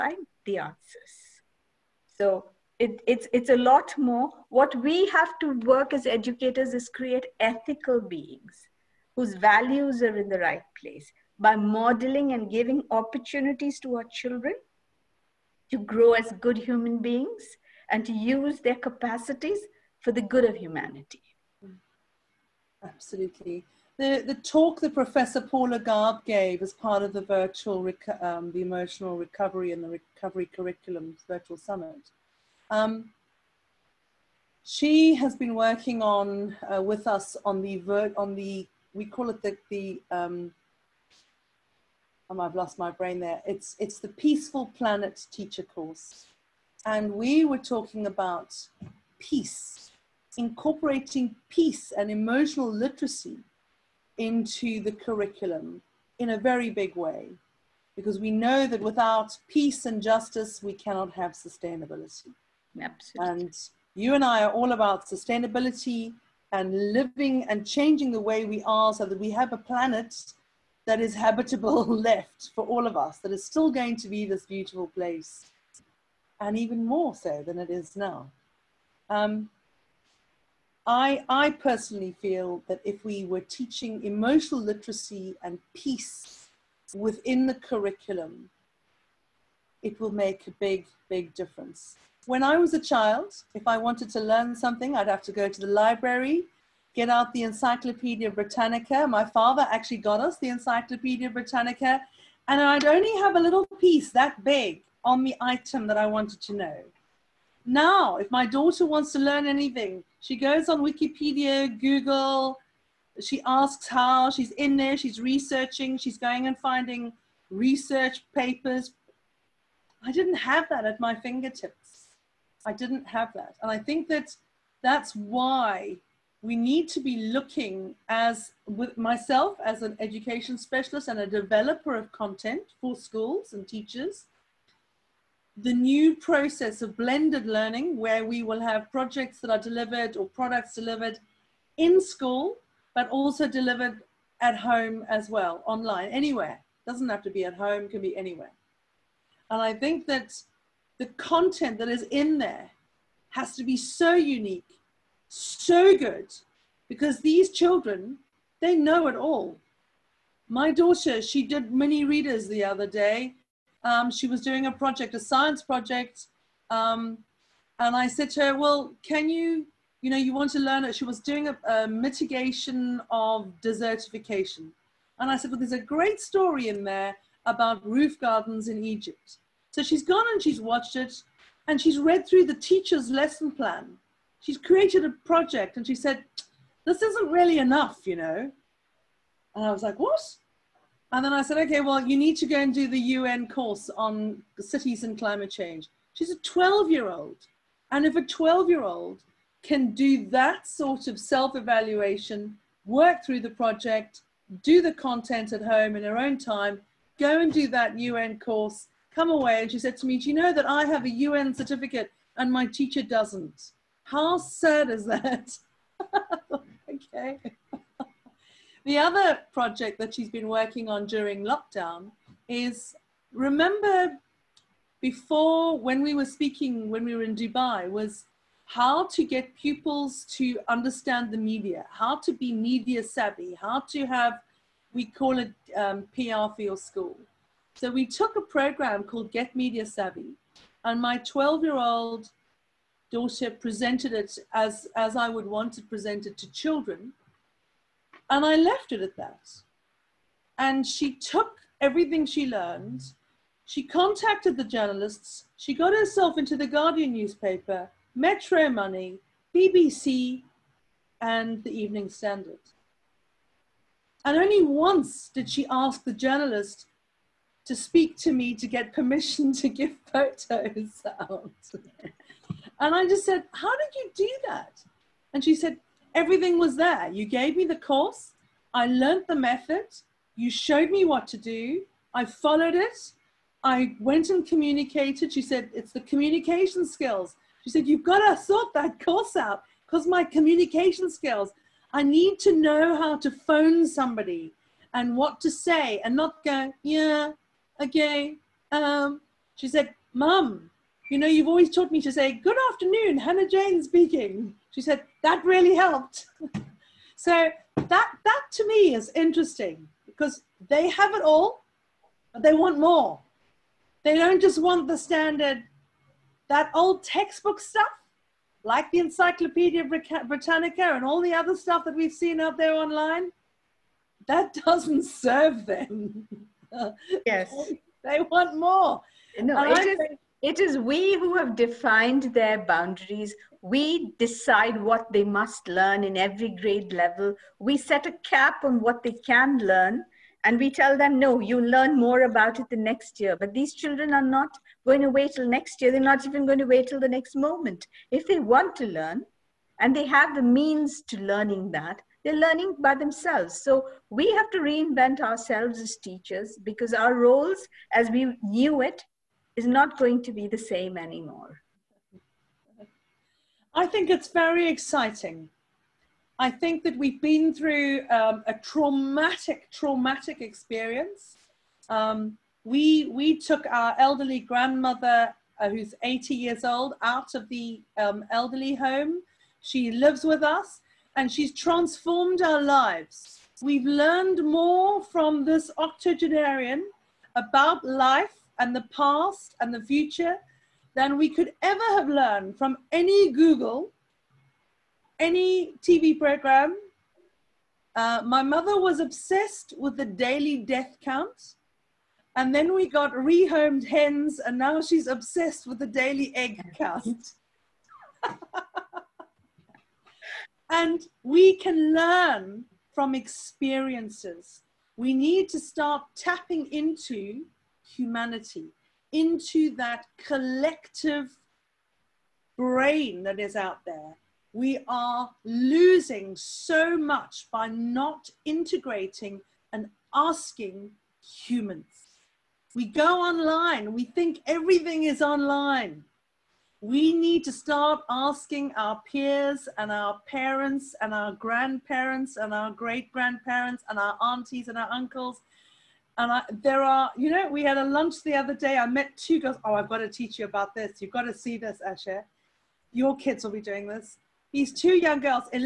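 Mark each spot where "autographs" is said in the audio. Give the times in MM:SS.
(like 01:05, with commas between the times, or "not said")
not said.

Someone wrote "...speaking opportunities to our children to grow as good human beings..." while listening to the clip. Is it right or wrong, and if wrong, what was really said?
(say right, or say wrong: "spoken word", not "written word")
wrong: "giving", not "speaking".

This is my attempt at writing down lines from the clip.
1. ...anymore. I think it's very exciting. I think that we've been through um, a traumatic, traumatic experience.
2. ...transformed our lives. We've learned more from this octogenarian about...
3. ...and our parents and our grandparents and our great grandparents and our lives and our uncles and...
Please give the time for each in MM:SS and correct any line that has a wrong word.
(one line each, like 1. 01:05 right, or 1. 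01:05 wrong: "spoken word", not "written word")
1. 06:00 right
2. 06:21 right
3. 07:19 wrong: "aunties", not "lives".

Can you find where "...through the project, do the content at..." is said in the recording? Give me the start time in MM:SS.
03:23.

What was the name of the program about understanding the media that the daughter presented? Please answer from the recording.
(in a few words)
Get Media Savvy.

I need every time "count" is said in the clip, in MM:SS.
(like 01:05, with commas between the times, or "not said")
06:41, 06:46.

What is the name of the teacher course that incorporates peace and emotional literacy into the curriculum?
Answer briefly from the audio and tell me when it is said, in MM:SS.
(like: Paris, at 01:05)
Peaceful Planet Teacher course, at 00:44.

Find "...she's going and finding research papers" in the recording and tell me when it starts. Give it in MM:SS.
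01:55.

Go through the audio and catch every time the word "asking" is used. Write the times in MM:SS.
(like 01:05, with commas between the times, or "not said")
07:10, 07:18.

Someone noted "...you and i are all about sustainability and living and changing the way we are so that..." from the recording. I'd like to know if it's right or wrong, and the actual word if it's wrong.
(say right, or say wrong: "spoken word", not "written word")
right.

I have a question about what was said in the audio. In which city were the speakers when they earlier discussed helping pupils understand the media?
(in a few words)
Dubai.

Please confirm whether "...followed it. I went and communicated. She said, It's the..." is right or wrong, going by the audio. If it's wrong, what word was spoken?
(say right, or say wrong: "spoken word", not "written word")
right.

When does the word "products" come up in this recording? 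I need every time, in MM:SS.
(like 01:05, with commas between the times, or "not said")
02:20.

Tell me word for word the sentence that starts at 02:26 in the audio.
Doesn't have to be at home, can be anywhere.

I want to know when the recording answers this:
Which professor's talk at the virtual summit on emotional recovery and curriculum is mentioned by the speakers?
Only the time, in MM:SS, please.
00:25.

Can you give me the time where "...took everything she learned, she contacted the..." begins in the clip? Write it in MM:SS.
04:11.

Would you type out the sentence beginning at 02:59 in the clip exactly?
So she's gone and she's watched it and she's read through the teacher's lesson plan.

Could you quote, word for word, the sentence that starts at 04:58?
Um, she said, Mum, you know, you've always taught me to say, Good afternoon, Hannah Jane speaking.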